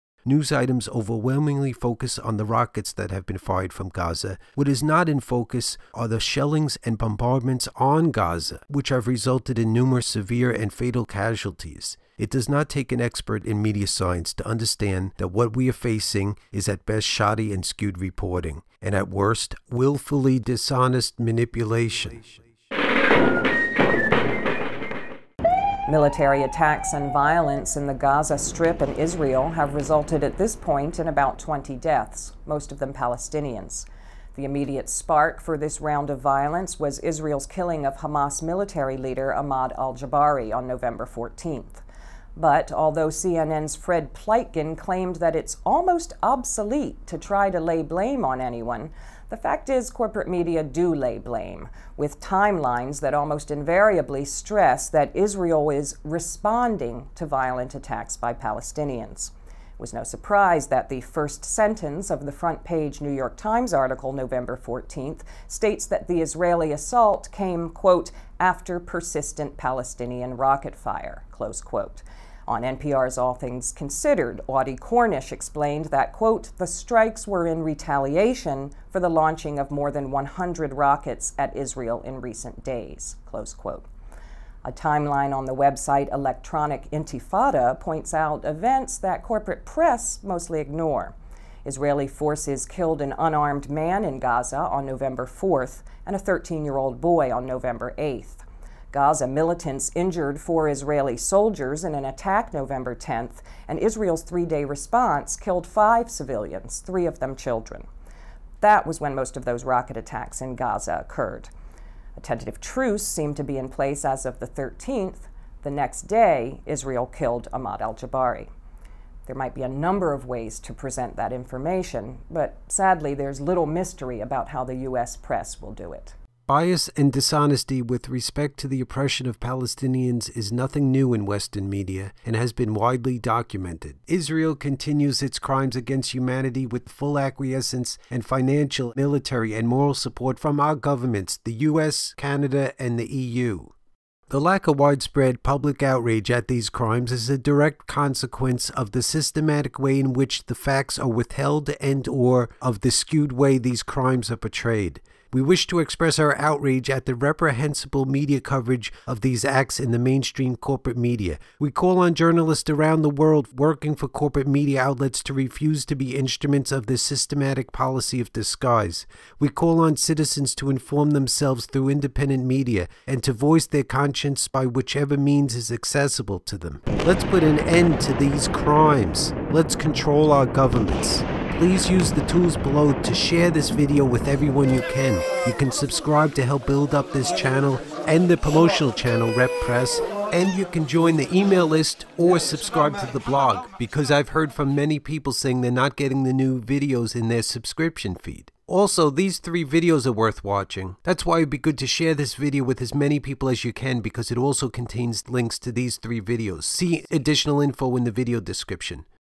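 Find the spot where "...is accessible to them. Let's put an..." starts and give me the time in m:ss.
2:55.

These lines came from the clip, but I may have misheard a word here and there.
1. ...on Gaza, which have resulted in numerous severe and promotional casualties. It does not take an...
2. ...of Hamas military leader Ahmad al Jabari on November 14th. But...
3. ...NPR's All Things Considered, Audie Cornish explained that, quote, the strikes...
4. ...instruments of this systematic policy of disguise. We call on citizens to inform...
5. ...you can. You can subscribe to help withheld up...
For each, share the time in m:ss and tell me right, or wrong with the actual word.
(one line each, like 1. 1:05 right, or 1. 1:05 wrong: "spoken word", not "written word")
1. 0:07 wrong: "fatal", not "promotional"
2. 0:37 right
3. 1:12 right
4. 2:46 right
5. 3:04 wrong: "build", not "withheld".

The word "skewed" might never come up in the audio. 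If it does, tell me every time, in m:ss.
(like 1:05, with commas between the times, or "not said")
0:17, 2:32.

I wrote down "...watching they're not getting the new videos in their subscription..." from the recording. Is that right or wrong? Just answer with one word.
wrong.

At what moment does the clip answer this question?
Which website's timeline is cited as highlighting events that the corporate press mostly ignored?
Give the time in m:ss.
1:26.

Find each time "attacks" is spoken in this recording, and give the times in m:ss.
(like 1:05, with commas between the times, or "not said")
0:26, 0:57, 1:42, 1:49.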